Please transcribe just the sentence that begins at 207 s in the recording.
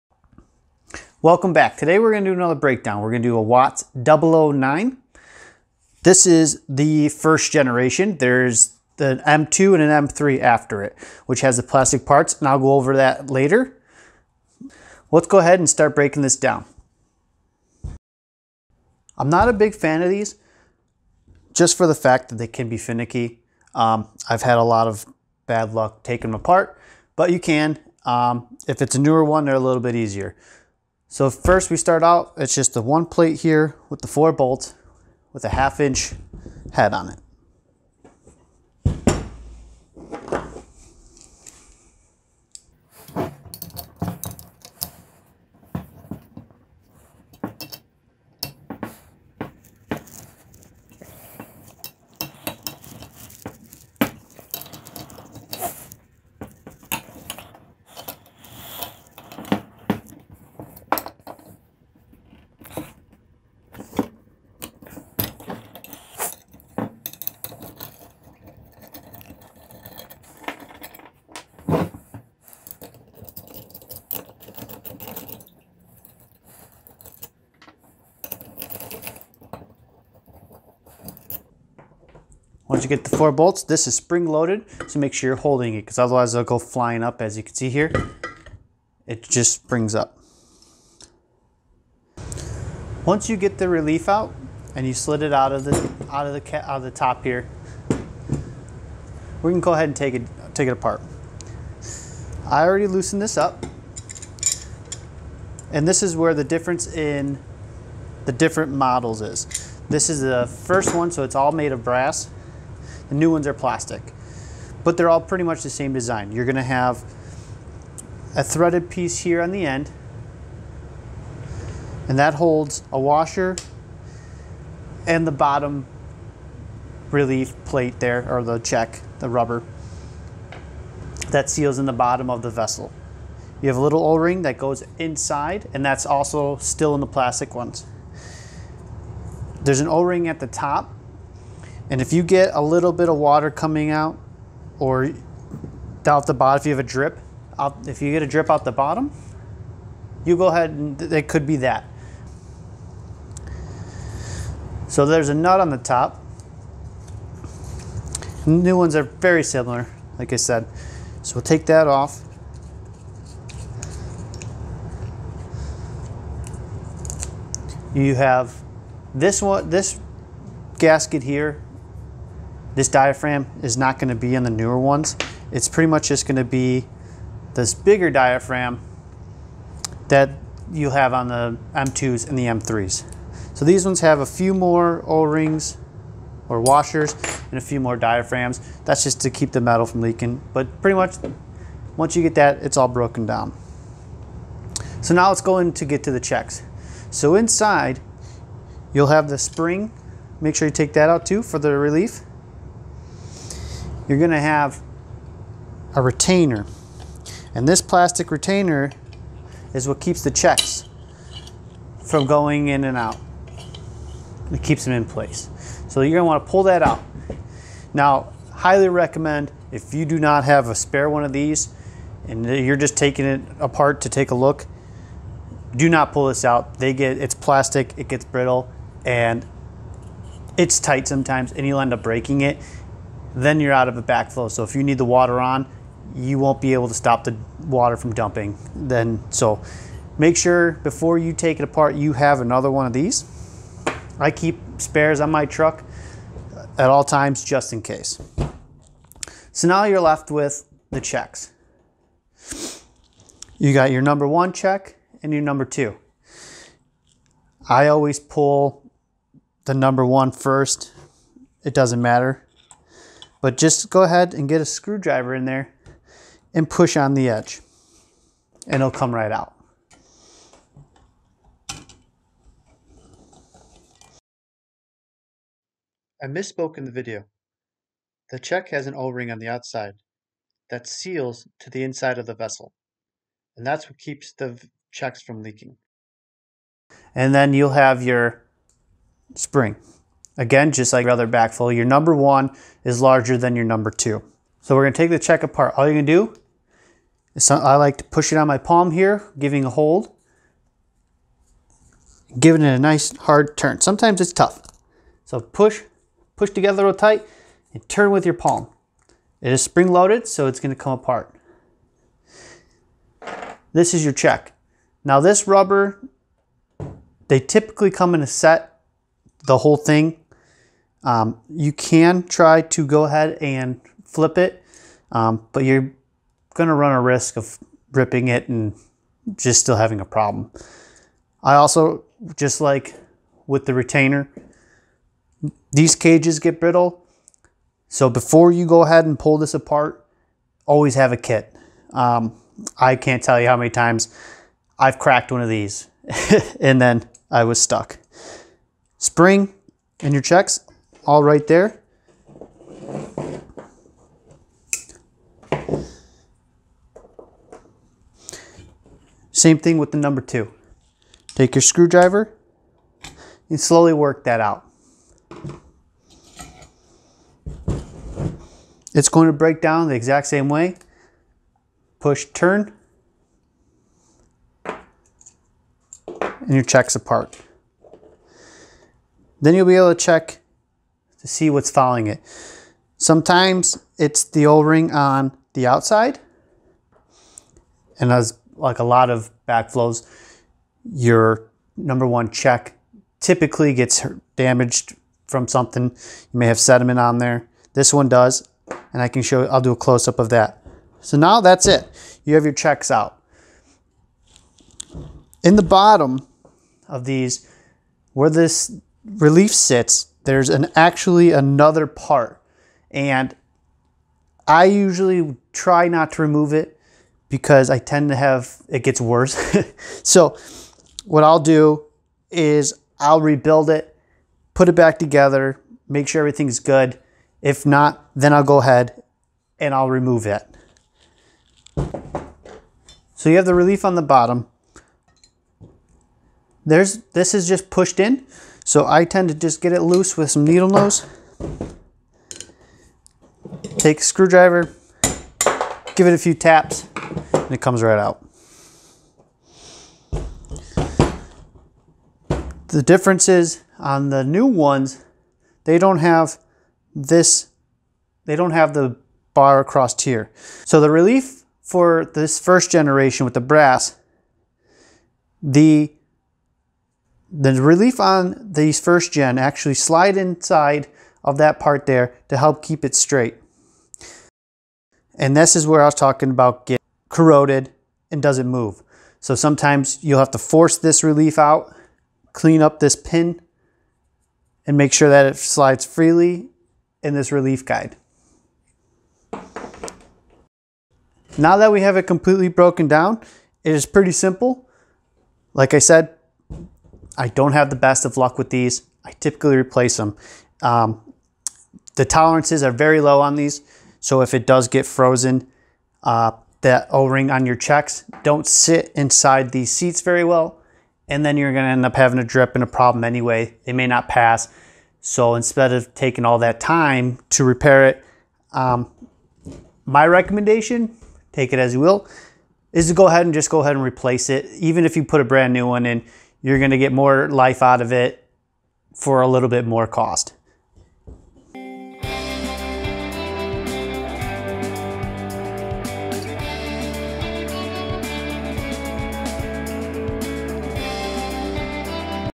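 And this plastic retainer is what keeps the checks from going in and out.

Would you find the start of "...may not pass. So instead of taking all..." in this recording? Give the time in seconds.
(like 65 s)
513 s.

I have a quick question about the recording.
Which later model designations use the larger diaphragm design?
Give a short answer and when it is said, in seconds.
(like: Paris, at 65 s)
M2 and M3, at 181 s.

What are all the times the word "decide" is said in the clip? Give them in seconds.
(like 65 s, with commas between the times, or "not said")
not said.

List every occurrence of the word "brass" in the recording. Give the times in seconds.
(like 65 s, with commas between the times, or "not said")
111 s, 463 s.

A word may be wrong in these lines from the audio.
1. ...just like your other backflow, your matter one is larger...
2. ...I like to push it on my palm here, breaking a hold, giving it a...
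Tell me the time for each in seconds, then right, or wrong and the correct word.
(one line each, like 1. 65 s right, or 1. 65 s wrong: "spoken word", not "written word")
1. 290 s wrong: "number", not "matter"
2. 297 s wrong: "giving", not "breaking".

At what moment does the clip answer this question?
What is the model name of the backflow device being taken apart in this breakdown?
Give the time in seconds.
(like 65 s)
3 s.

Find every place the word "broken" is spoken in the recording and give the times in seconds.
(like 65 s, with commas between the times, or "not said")
192 s, 492 s.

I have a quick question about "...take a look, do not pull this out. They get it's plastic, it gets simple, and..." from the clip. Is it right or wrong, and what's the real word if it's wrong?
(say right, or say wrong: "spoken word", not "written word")
wrong: "brittle", not "simple".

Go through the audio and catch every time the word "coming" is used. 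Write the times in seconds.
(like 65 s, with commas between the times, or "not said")
143 s.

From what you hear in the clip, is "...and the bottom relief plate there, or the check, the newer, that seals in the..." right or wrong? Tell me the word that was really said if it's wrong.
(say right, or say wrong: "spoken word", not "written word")
wrong: "rubber", not "newer".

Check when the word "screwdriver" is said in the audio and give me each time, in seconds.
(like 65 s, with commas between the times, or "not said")
264 s, 361 s, 444 s.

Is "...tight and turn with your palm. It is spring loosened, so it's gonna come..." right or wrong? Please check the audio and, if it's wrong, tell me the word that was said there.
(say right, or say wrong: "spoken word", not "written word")
wrong: "loaded", not "loosened".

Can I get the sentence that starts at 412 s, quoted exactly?
And I usually try not to remove it because I tend to have, it gets worse.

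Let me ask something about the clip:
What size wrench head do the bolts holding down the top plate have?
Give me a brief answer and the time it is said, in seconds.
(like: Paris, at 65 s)
half inch, at 35 s.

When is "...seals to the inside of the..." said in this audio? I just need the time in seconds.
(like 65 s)
280 s.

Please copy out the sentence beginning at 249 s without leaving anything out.
So now you're left with the checks.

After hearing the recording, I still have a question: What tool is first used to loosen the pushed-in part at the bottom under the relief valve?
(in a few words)
needle nose.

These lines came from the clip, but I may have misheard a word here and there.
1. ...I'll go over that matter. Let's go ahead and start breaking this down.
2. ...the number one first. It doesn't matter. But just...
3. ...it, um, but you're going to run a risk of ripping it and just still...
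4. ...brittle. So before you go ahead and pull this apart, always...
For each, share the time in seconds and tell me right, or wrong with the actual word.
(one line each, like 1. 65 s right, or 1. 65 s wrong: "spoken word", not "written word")
1. 12 s wrong: "later", not "matter"
2. 259 s right
3. 324 s right
4. 336 s right.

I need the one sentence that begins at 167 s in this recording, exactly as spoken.
You have this one, this gasket here this diaphragm is not going to be in the newer ones.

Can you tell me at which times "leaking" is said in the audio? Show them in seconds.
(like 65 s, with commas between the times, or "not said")
189 s, 285 s.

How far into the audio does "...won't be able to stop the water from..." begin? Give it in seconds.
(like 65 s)
236 s.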